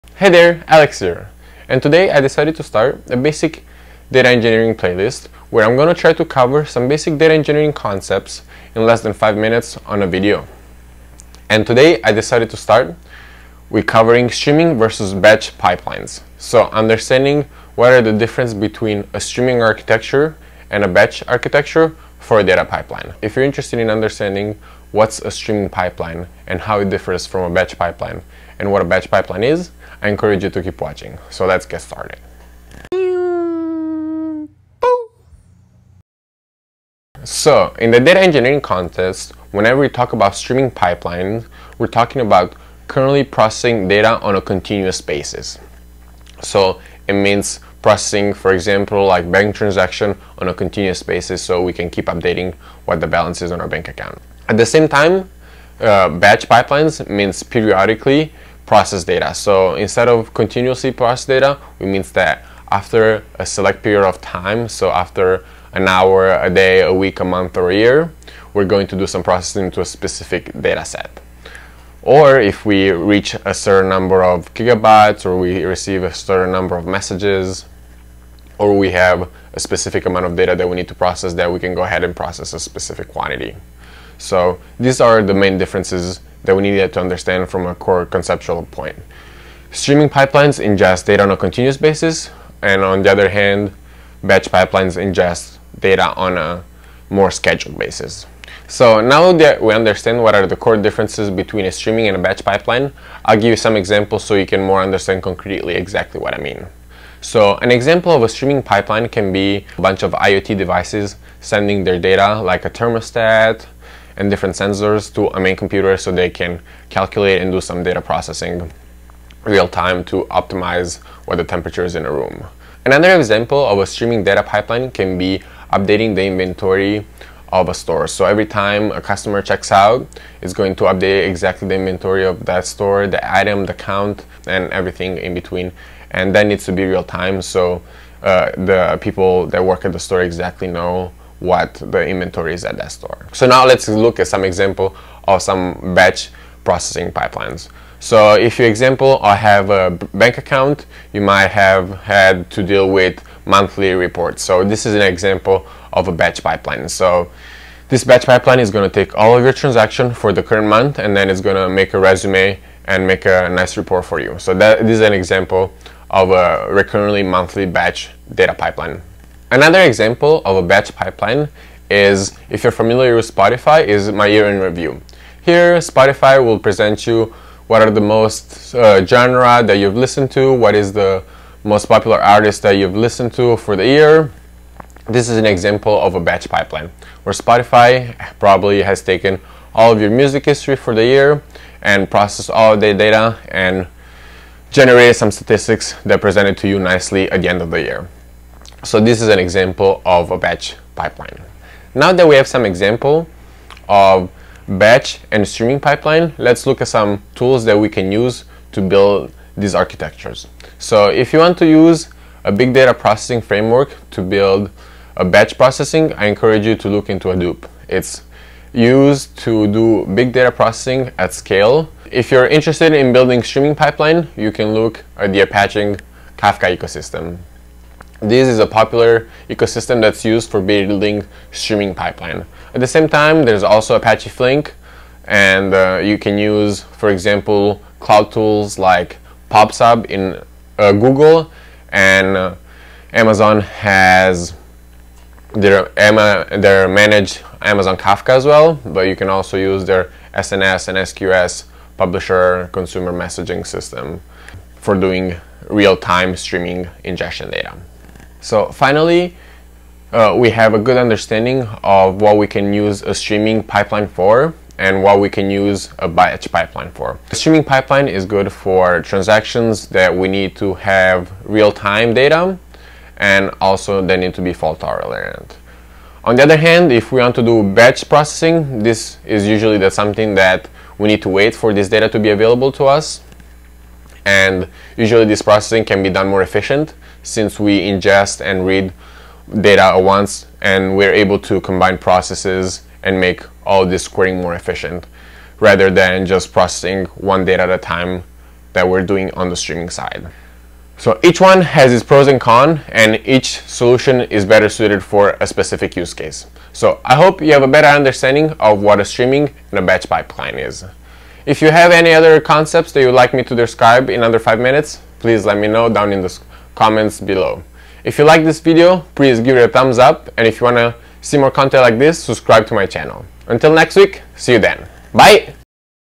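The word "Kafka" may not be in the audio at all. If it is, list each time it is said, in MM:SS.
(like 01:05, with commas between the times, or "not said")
03:46, 04:07.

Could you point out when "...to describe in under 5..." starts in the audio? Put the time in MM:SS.
05:13.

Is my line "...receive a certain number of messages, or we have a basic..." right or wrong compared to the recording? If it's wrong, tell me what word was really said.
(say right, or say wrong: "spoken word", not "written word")
wrong: "specific", not "basic".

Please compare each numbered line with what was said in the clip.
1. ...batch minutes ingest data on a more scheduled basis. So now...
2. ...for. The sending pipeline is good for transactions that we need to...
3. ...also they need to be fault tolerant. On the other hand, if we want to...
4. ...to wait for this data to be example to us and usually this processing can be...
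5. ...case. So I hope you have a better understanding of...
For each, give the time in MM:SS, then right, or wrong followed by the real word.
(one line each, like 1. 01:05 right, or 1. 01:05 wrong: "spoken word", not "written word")
1. 01:34 wrong: "pipelines", not "minutes"
2. 04:26 wrong: "streaming", not "sending"
3. 04:33 right
4. 04:41 wrong: "available", not "example"
5. 05:06 right.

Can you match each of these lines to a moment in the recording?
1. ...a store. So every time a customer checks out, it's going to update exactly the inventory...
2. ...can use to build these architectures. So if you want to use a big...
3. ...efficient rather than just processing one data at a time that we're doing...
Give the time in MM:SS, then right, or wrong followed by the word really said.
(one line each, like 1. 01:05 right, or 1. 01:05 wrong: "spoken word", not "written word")
1. 02:07 right
2. 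03:27 right
3. 04:54 right.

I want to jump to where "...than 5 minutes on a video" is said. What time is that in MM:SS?
00:09.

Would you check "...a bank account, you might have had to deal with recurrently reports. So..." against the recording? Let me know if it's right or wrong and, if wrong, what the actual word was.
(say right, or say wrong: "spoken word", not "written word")
wrong: "monthly", not "recurrently".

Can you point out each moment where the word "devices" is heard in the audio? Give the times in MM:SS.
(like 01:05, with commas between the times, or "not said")
01:50.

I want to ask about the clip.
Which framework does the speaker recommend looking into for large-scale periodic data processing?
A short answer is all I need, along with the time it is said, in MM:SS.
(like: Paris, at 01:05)
Hadoop, at 03:37.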